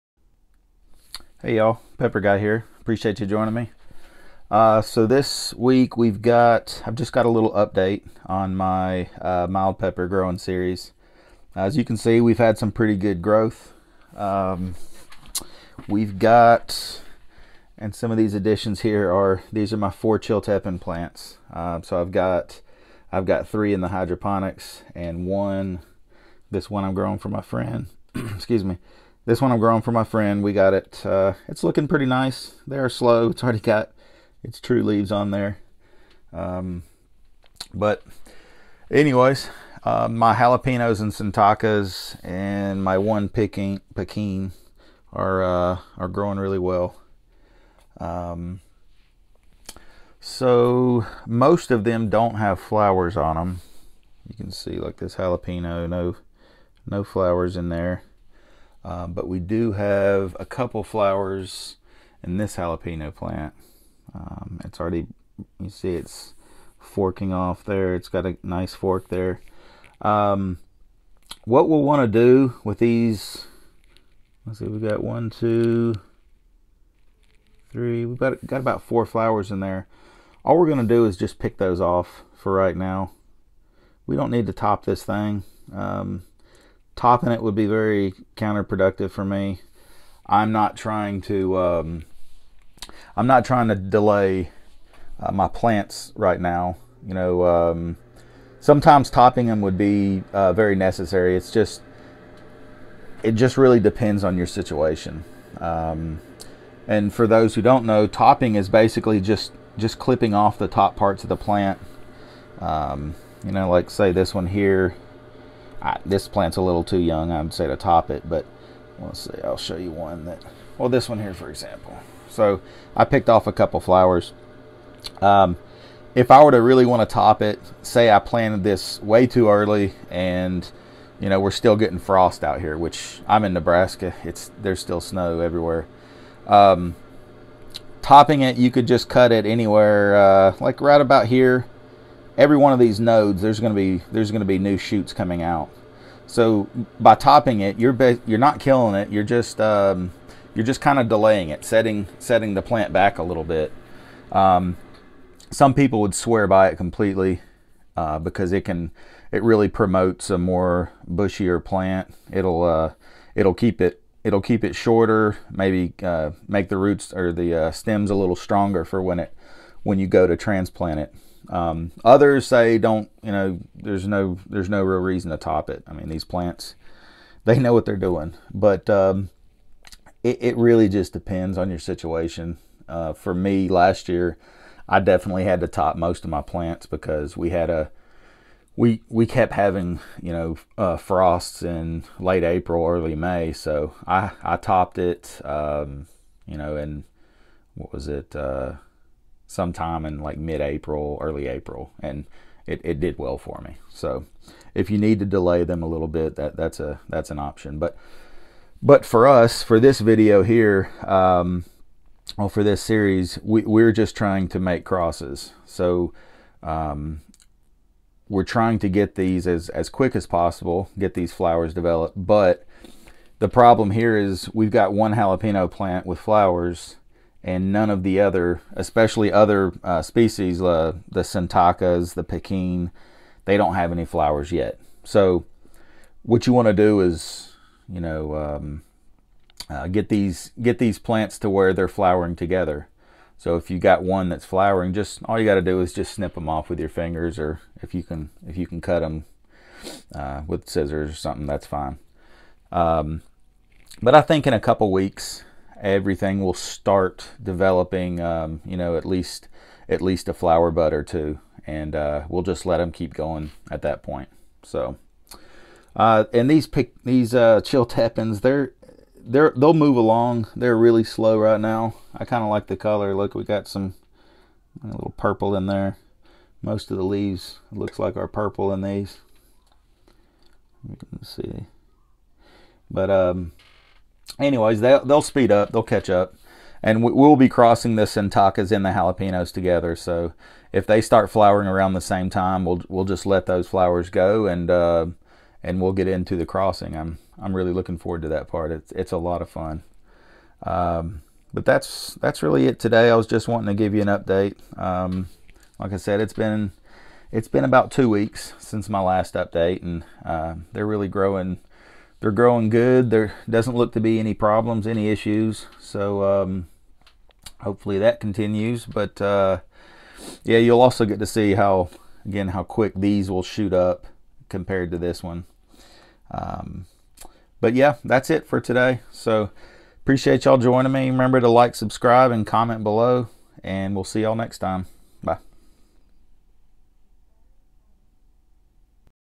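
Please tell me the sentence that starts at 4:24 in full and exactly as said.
So, uh, and these pick these uh, Chiltepins, they're they're they'll move along.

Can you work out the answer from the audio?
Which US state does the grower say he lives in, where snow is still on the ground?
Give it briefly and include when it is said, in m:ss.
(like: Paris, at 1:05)
Nebraska, at 2:13.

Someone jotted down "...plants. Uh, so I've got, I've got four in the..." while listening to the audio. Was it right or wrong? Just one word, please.
wrong.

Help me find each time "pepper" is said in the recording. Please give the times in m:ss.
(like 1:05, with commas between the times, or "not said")
0:01, 0:09.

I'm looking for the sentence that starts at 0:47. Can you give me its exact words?
Um, so most of them don't have flowers on them.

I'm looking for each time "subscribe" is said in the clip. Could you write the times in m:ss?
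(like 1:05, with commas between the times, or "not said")
5:31.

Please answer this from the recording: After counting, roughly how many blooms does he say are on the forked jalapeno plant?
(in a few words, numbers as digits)
4.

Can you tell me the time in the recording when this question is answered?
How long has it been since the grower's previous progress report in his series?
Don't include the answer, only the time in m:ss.
5:07.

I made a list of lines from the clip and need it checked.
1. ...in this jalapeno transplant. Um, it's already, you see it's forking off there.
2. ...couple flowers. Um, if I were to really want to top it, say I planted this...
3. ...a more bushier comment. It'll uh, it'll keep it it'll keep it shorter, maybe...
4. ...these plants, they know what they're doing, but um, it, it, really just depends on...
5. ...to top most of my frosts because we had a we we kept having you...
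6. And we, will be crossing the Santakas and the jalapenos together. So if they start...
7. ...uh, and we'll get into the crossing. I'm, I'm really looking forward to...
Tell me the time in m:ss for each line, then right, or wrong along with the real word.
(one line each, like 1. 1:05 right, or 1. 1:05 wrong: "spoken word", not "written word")
1. 1:02 wrong: "plant", not "transplant"
2. 2:03 right
3. 2:40 wrong: "plant", not "comment"
4. 2:56 right
5. 3:05 wrong: "plants", not "frosts"
6. 4:46 right
7. 4:54 right.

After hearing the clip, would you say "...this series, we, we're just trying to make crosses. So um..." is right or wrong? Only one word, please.
right.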